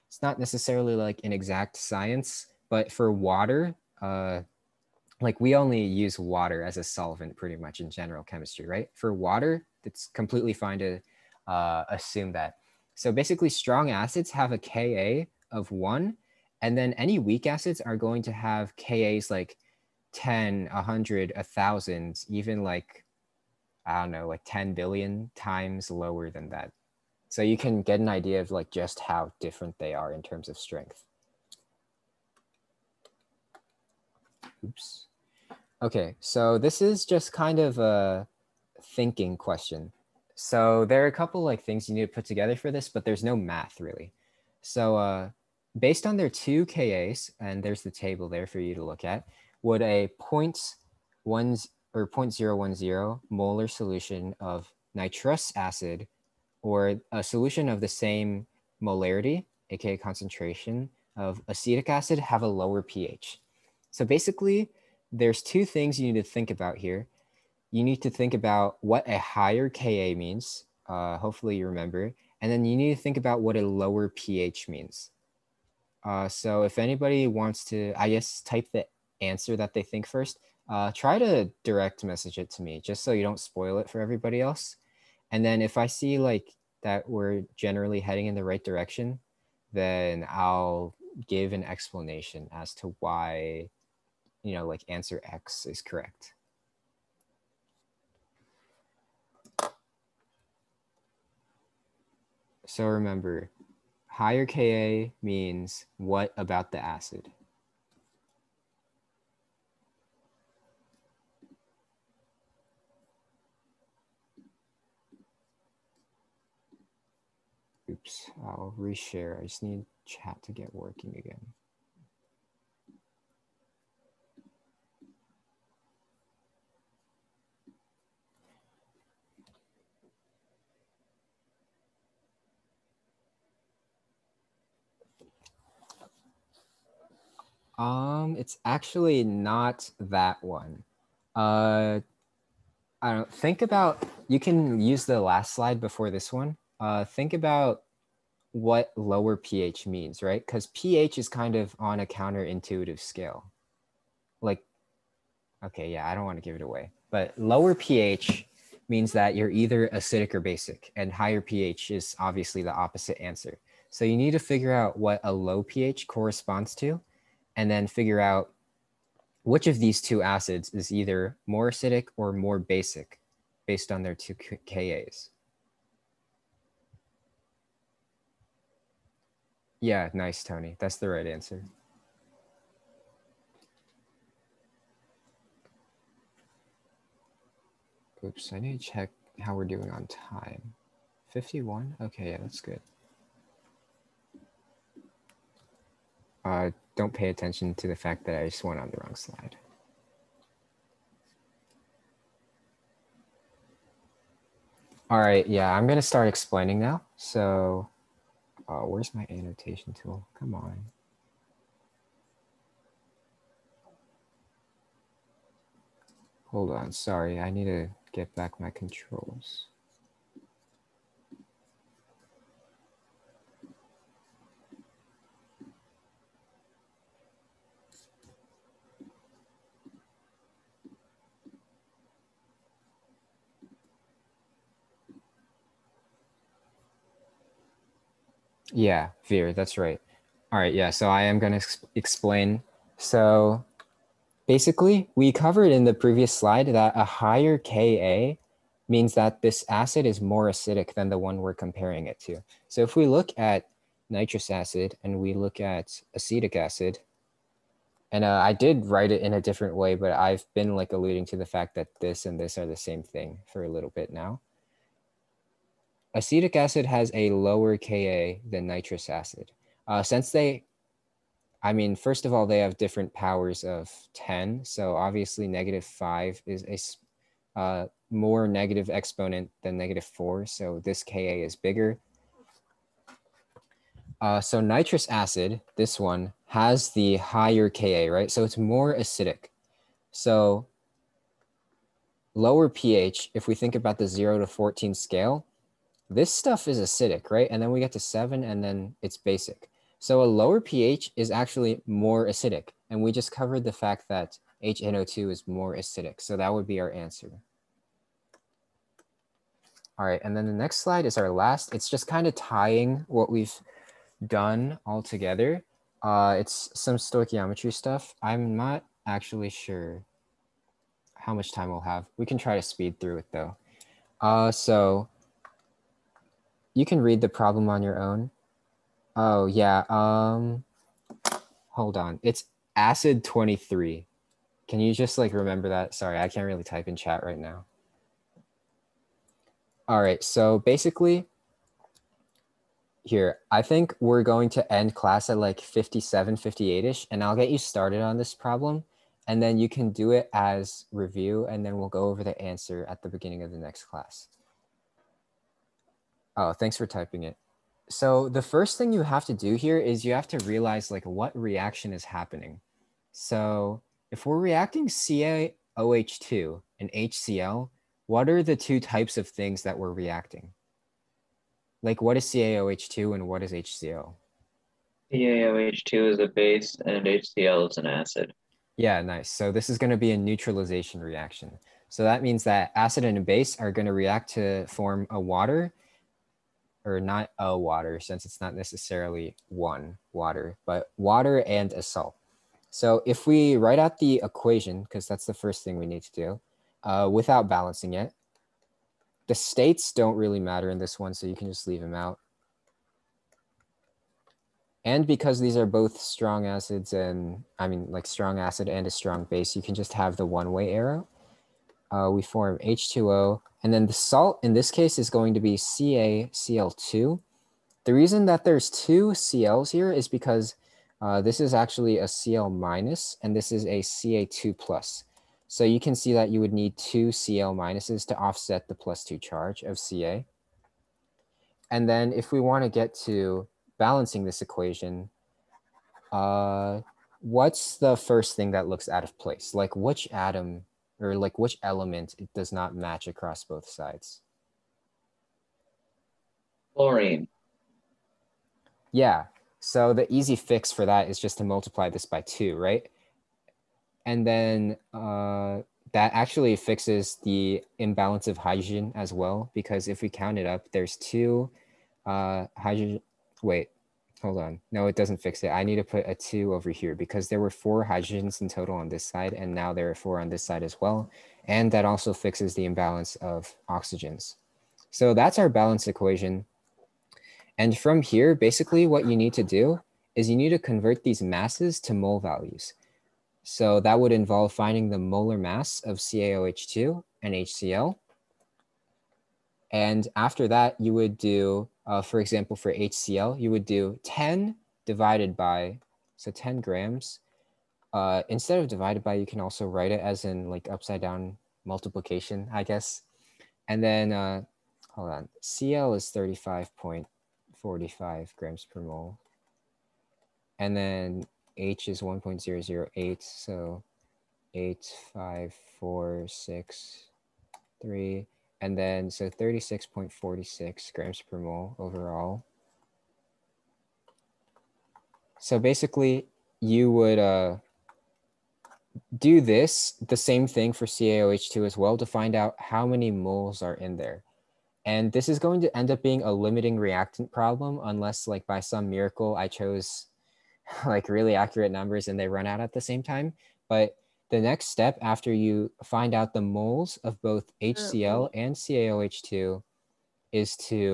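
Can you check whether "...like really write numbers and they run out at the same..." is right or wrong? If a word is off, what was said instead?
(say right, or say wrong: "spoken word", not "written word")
wrong: "accurate", not "write".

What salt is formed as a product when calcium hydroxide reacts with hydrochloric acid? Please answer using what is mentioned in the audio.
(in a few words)
CaCl2.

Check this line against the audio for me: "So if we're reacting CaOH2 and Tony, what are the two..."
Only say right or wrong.
wrong.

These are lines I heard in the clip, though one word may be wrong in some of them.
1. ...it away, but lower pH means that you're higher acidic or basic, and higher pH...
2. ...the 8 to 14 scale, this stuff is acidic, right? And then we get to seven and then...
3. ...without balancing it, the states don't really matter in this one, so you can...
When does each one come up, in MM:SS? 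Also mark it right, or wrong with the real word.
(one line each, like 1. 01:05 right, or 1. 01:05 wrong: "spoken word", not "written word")
1. 02:36 wrong: "either", not "higher"
2. 04:53 wrong: "0", not "8"
3. 06:37 right.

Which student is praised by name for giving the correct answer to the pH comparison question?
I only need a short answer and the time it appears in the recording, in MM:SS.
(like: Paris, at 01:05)
Tony, at 03:00.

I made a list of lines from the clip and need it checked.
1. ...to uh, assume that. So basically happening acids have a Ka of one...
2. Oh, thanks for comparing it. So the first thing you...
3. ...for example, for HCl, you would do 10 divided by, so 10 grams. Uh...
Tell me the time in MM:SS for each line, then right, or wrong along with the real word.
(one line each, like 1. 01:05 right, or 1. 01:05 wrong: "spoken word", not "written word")
1. 00:10 wrong: "strong", not "happening"
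2. 05:56 wrong: "typing", not "comparing"
3. 08:12 right.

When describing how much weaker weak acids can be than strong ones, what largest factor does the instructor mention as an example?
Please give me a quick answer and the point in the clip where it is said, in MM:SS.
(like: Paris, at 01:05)
10 billion, at 00:24.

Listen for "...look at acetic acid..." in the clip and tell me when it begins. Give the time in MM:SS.
04:15.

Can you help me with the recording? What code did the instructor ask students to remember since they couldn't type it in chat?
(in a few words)
Acid twenty three.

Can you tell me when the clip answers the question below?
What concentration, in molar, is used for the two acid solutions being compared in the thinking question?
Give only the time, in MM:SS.
00:52.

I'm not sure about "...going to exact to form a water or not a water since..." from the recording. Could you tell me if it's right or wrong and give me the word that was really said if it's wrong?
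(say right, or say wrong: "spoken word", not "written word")
wrong: "react", not "exact".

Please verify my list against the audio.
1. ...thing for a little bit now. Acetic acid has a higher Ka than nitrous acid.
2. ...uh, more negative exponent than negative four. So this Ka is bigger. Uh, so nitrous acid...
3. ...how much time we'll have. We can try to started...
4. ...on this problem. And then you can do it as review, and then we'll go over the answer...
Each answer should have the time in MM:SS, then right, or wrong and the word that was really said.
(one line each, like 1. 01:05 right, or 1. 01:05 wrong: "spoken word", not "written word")
1. 04:23 wrong: "lower", not "higher"
2. 04:37 right
3. 05:21 wrong: "speed", not "started"
4. 05:48 right.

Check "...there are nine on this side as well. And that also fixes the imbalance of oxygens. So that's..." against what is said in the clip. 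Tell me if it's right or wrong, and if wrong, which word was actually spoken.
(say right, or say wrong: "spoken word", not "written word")
wrong: "four", not "nine".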